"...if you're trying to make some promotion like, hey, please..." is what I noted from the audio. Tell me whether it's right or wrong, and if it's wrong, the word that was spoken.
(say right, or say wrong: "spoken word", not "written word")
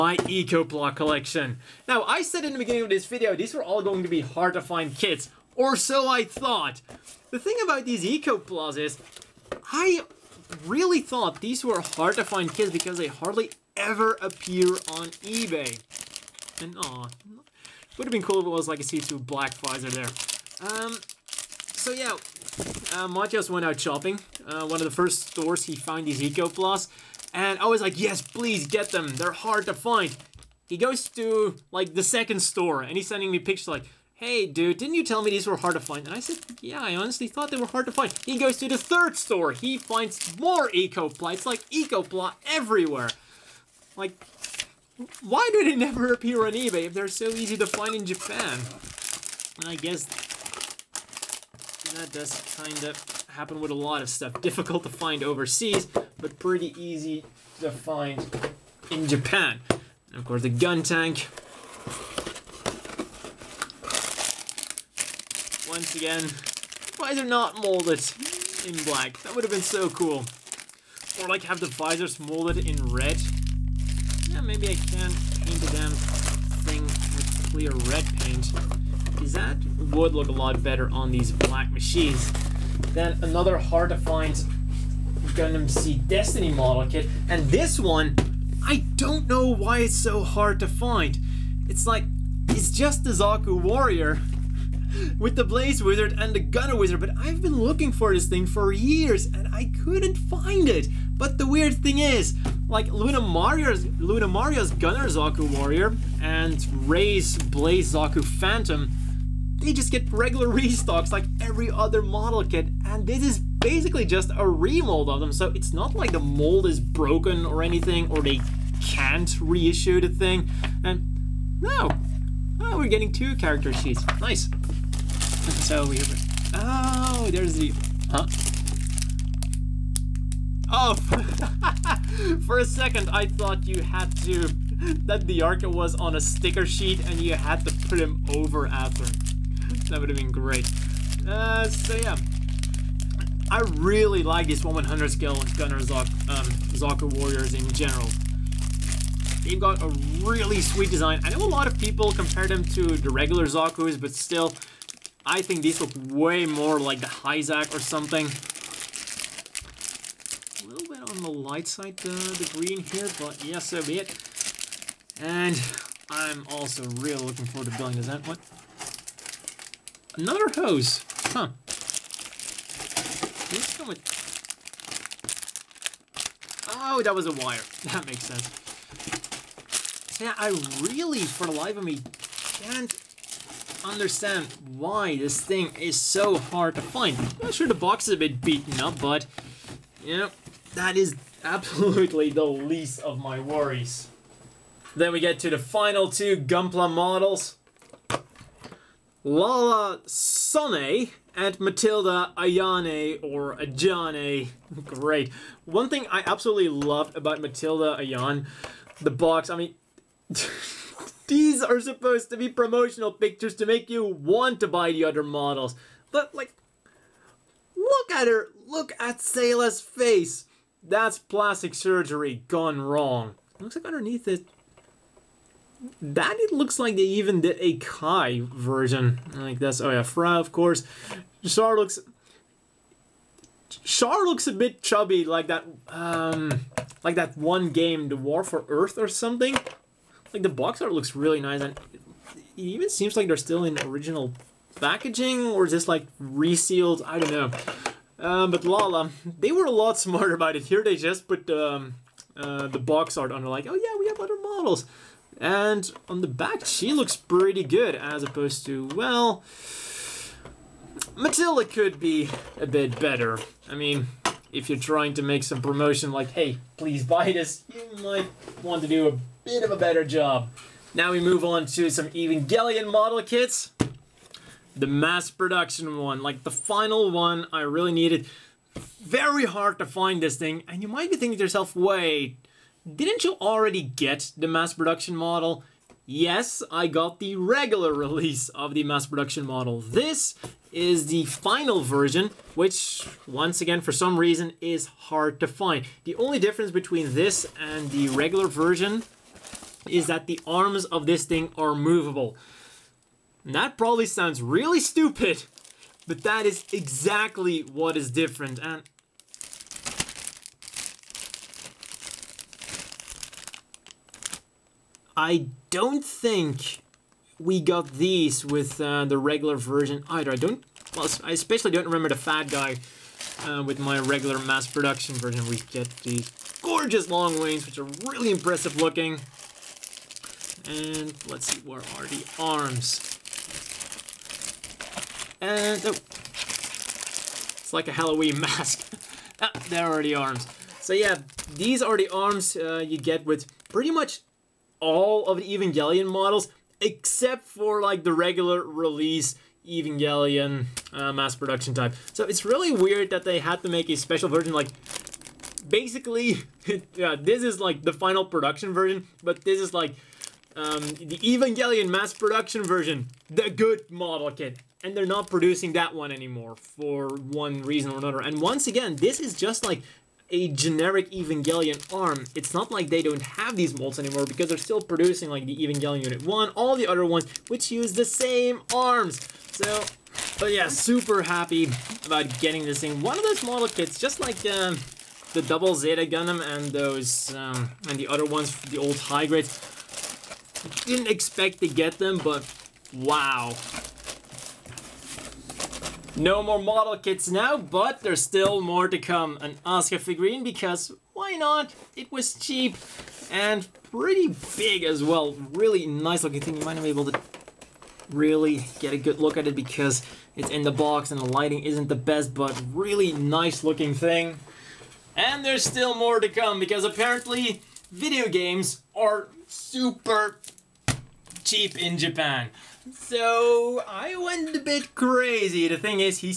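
right.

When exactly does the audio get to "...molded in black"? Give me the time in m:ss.
1:07.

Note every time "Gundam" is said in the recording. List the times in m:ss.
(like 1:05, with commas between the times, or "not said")
1:25, 6:26.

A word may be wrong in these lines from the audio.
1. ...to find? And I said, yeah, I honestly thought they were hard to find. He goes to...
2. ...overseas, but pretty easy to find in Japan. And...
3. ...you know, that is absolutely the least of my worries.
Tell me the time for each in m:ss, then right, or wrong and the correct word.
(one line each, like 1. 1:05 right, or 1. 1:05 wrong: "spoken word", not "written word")
1. 0:35 right
2. 0:55 right
3. 3:10 right.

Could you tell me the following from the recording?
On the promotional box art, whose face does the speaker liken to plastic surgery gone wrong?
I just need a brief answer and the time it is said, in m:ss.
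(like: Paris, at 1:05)
Sayla, at 3:39.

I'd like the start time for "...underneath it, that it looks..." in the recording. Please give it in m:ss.
3:43.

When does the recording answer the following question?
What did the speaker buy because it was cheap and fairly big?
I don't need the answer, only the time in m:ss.
6:39.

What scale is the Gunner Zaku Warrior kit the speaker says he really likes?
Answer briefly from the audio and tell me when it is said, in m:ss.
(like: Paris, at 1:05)
1/100, at 2:24.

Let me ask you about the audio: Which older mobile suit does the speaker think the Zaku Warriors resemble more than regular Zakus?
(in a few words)
Hyzak.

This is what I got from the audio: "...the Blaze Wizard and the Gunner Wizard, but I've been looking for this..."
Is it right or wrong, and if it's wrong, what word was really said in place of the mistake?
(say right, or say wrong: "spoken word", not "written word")
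right.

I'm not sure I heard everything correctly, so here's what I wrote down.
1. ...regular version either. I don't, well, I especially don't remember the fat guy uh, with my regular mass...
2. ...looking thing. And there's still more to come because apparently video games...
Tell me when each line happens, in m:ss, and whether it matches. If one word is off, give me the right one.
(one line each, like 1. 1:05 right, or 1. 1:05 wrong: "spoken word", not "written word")
1. 5:19 right
2. 6:53 right.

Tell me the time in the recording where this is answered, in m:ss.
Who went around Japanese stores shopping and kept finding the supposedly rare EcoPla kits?
0:23.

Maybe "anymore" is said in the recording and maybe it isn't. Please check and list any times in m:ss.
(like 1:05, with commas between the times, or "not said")
6:06, 6:13.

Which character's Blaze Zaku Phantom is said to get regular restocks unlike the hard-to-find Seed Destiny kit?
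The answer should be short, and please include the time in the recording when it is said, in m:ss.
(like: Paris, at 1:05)
Ray, at 1:46.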